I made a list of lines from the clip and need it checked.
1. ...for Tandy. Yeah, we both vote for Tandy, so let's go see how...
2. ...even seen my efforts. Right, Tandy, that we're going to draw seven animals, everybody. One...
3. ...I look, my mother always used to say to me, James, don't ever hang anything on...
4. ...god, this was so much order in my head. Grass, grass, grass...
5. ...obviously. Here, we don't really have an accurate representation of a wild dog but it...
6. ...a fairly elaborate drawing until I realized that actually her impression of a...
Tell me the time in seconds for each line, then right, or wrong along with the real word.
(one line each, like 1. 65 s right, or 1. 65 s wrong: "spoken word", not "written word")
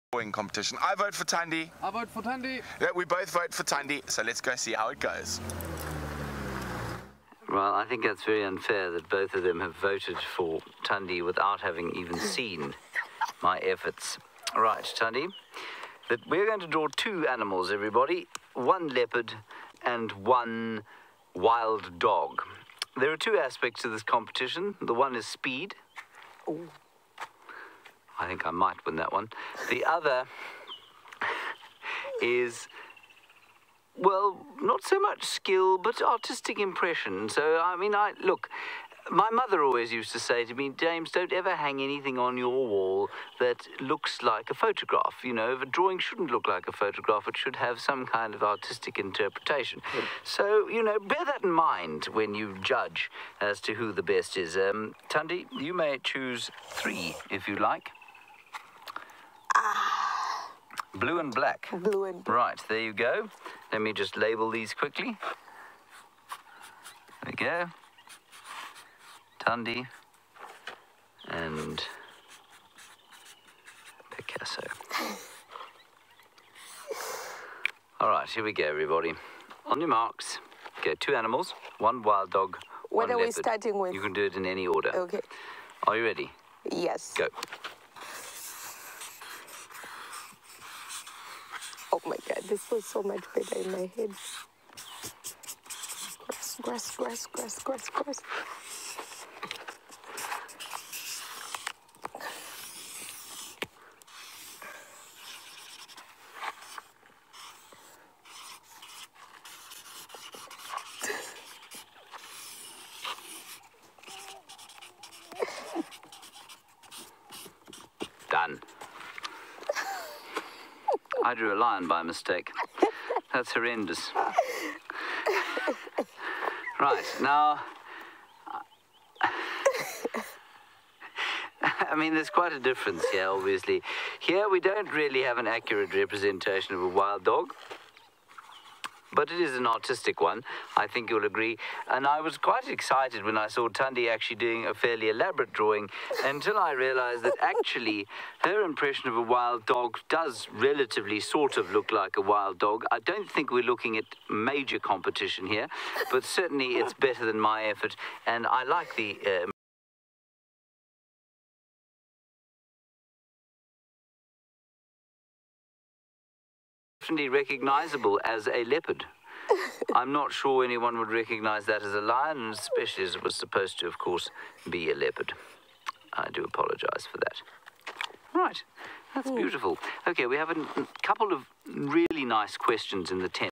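1. 2 s right
2. 11 s wrong: "two", not "seven"
3. 37 s right
4. 92 s wrong: "better", not "order"
5. 133 s right
6. 144 s right.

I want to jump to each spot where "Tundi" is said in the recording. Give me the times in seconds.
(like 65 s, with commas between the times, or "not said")
69 s, 143 s.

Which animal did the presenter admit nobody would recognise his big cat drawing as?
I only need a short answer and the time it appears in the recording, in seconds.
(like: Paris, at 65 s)
Lion, at 171 s.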